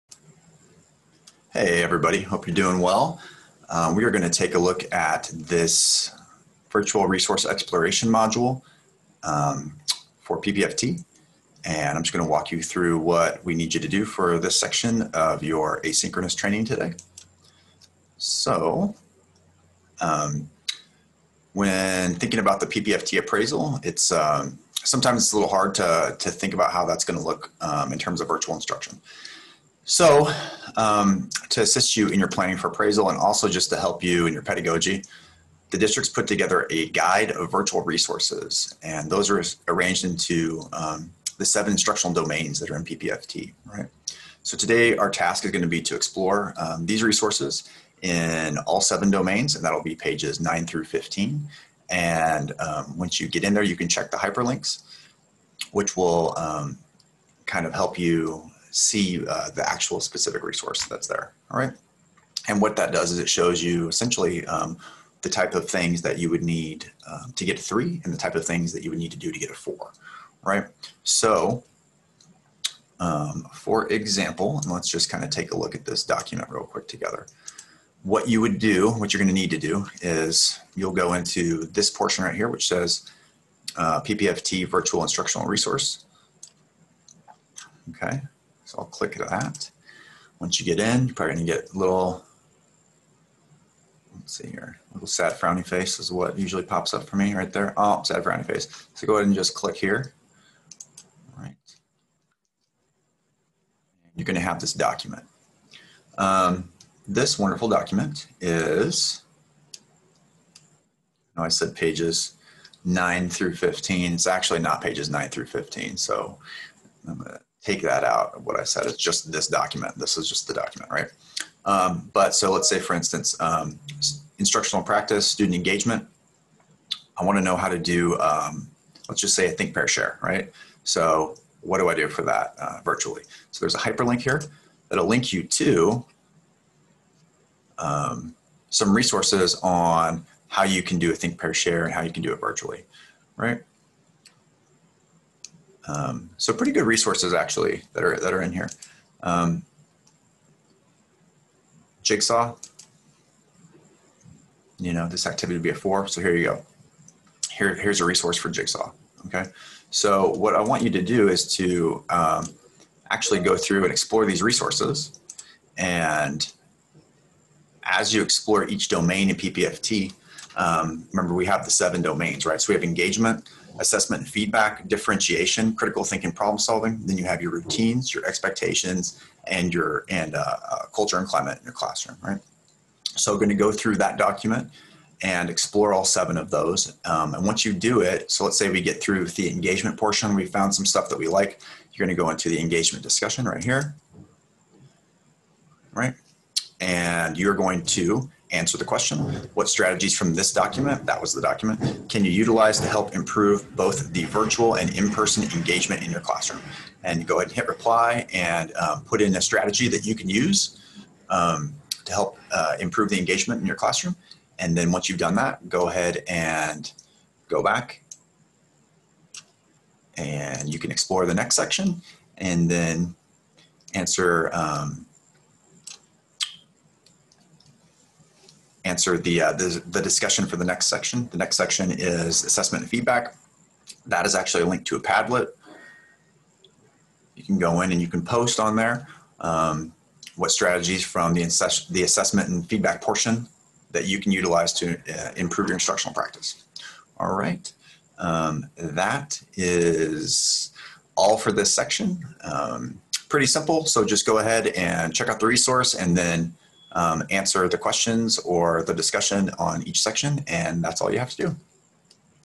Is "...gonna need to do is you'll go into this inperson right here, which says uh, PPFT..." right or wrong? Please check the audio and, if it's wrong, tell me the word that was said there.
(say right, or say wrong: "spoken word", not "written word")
wrong: "portion", not "inperson".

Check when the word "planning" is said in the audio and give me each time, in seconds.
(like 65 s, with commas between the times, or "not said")
32 s.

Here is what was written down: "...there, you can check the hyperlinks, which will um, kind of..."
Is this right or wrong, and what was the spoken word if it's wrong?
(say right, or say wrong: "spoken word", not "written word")
right.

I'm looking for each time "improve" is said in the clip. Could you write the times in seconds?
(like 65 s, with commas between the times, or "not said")
203 s, 212 s, 245 s.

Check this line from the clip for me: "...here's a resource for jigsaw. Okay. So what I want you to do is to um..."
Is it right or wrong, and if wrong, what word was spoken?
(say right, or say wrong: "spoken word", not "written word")
right.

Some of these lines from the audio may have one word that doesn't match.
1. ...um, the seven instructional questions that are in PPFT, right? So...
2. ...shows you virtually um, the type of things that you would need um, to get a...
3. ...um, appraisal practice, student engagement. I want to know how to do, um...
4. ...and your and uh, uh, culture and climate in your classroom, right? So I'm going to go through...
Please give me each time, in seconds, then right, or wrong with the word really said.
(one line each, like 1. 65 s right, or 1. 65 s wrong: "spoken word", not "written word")
1. 40 s wrong: "domains", not "questions"
2. 63 s wrong: "essentially", not "virtually"
3. 123 s wrong: "instructional", not "appraisal"
4. 179 s right.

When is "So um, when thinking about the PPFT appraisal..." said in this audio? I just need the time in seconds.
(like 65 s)
18 s.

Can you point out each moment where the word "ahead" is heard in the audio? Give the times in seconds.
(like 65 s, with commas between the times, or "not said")
99 s, 207 s, 215 s, 254 s.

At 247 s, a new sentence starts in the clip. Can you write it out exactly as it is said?
All right, um, that is all for this section.